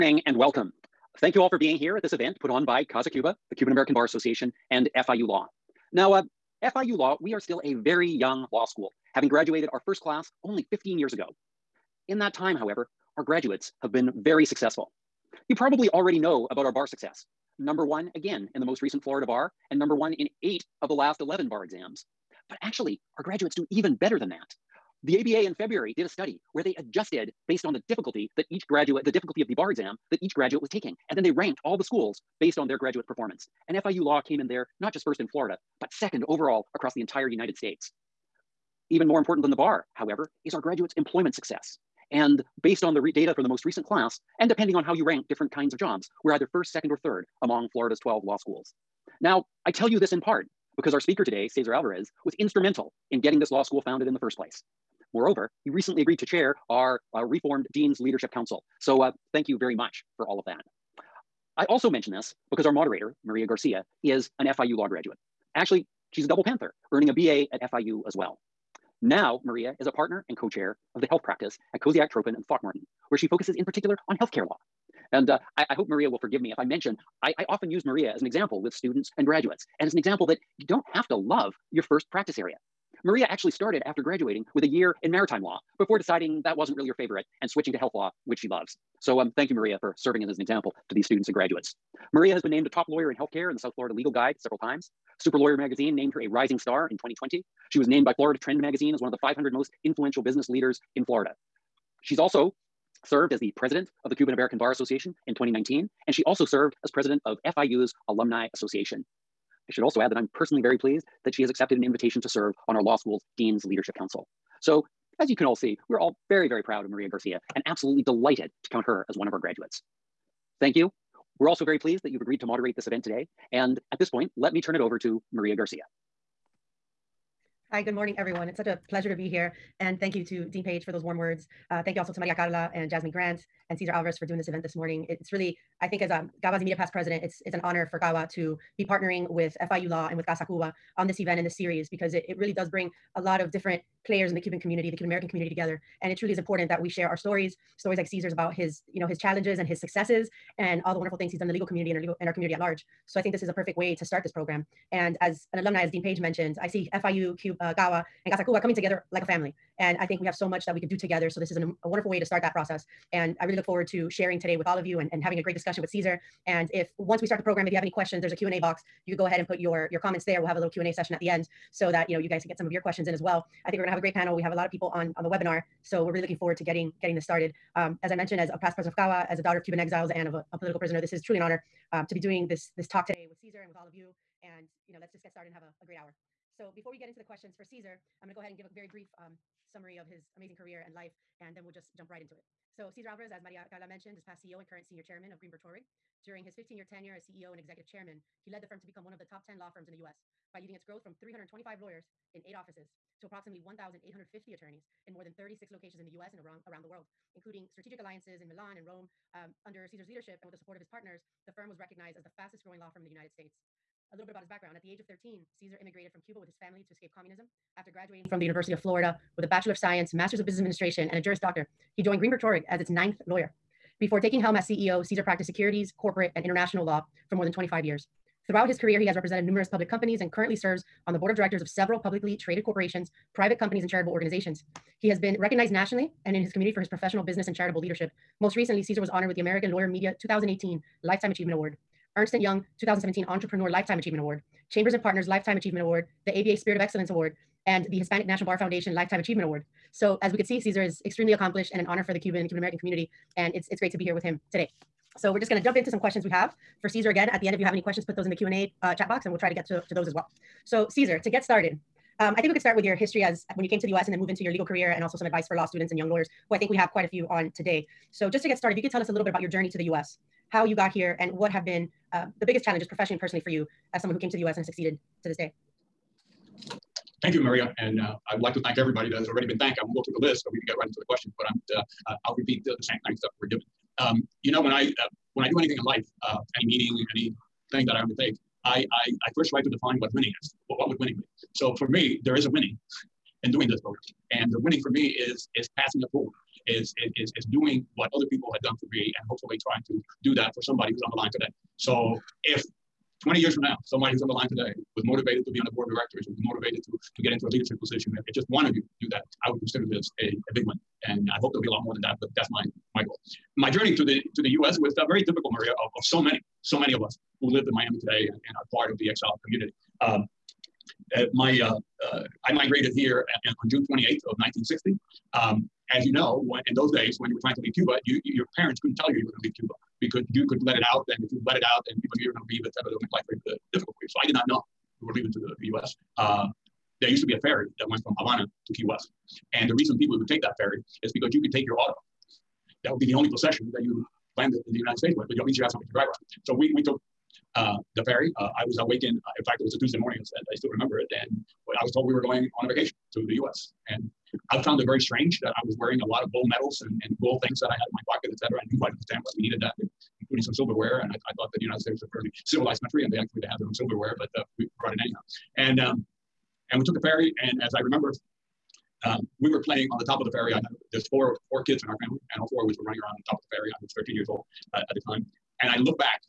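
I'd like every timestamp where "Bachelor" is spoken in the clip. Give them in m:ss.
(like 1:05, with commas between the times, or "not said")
3:39.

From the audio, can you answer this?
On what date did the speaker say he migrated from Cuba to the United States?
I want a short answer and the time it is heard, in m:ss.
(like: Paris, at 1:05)
June 28th, 1960, at 5:23.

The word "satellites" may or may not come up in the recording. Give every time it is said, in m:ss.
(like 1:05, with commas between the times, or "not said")
not said.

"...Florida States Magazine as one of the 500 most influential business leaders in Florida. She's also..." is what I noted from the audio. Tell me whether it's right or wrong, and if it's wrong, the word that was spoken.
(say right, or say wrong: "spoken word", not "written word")
wrong: "Trend", not "States".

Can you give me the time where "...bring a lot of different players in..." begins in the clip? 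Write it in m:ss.
2:22.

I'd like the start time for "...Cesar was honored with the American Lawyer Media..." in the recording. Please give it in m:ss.
3:58.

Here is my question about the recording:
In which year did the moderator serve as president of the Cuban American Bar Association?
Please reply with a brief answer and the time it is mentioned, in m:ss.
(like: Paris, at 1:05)
2019, at 1:45.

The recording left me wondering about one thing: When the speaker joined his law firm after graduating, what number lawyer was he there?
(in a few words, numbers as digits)
ninth.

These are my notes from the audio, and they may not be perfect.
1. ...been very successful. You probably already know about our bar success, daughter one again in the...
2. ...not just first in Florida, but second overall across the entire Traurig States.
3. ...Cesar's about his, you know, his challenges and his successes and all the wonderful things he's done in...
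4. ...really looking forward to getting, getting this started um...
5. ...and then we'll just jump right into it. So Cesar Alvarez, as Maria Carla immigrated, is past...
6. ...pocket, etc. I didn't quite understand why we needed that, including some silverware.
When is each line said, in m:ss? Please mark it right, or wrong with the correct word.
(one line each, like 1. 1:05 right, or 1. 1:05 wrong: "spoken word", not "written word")
1. 0:13 wrong: "number", not "daughter"
2. 0:34 wrong: "United", not "Traurig"
3. 2:28 right
4. 2:56 right
5. 3:11 wrong: "mentioned", not "immigrated"
6. 5:58 right.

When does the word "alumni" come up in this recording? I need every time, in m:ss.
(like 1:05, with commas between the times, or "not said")
1:48, 2:35.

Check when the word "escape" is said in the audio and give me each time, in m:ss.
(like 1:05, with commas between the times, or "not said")
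3:36.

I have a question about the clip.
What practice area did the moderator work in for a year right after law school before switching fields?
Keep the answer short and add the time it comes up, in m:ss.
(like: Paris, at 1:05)
maritime law, at 1:25.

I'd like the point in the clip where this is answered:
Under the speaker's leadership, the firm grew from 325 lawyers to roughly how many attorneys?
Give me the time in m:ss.
3:23.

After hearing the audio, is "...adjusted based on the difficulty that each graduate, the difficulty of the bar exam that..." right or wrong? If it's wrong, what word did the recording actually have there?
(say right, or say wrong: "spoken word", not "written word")
right.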